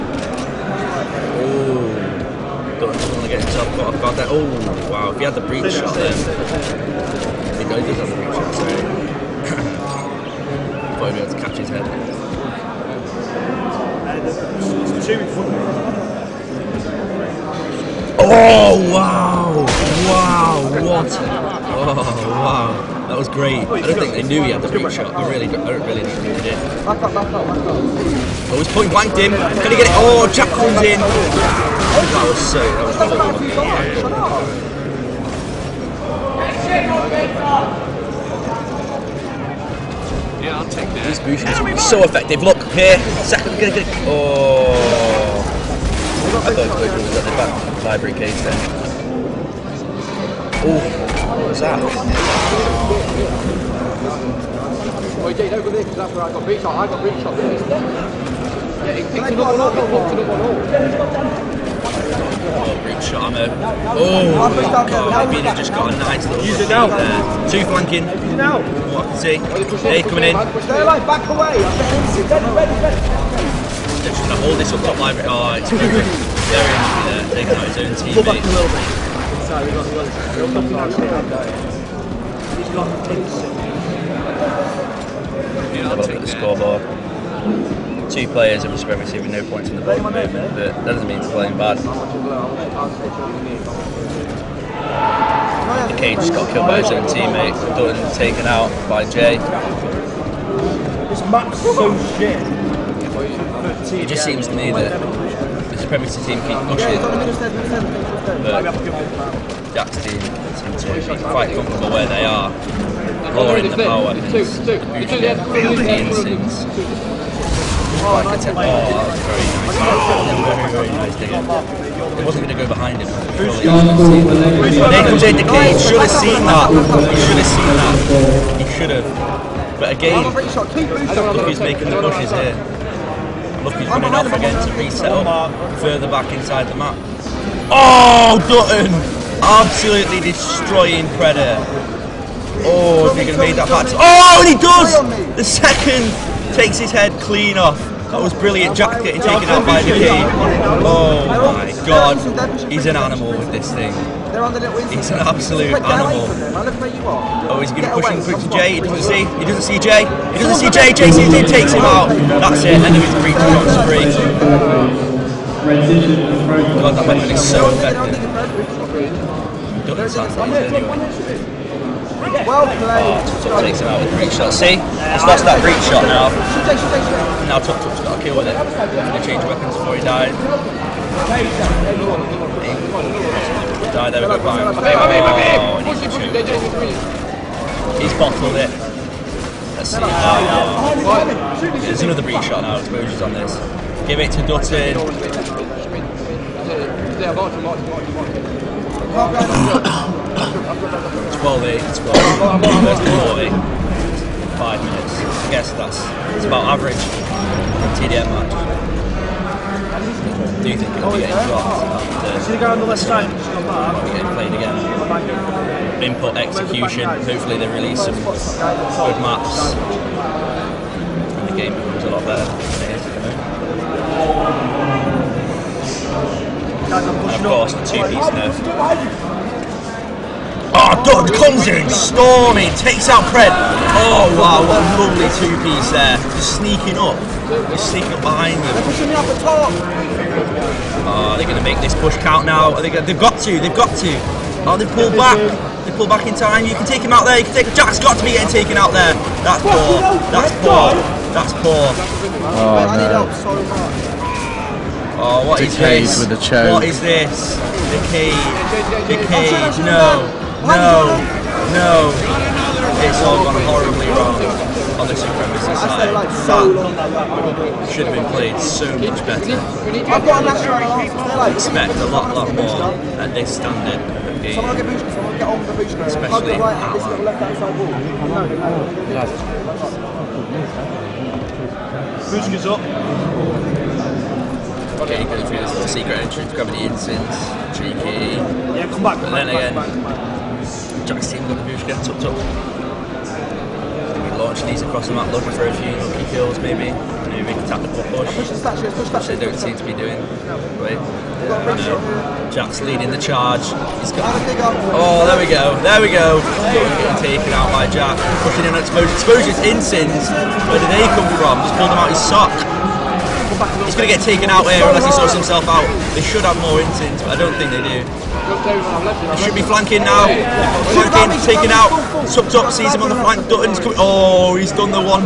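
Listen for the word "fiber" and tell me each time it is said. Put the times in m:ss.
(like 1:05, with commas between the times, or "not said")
not said.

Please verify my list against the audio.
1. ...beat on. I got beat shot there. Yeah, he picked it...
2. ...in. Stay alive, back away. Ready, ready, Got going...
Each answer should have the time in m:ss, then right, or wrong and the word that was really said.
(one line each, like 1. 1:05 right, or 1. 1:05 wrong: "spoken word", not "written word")
1. 0:56 right
2. 1:10 wrong: "Just", not "Got".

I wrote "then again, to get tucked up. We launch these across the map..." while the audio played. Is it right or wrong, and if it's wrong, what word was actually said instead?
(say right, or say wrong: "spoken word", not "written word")
right.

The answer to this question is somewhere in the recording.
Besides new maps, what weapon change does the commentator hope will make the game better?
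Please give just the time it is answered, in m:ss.
3:47.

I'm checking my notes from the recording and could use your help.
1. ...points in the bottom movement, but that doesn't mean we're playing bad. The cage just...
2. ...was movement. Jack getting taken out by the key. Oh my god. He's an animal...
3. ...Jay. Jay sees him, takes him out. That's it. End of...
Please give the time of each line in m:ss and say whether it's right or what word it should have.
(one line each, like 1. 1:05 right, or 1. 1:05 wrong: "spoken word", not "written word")
1. 1:29 right
2. 2:28 wrong: "brilliant", not "movement"
3. 2:40 right.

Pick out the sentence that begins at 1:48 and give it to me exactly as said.
But Jack's team seem to be quite comfortable where they are, lowering the power weapons, the instance.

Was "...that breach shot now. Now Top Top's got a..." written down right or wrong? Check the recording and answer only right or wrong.
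right.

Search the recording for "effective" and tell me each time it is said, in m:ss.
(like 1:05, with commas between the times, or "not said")
0:42, 2:47.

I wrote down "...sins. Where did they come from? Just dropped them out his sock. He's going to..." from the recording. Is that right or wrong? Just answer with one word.
wrong.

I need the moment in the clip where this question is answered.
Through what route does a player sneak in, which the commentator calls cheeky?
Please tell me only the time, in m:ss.
4:45.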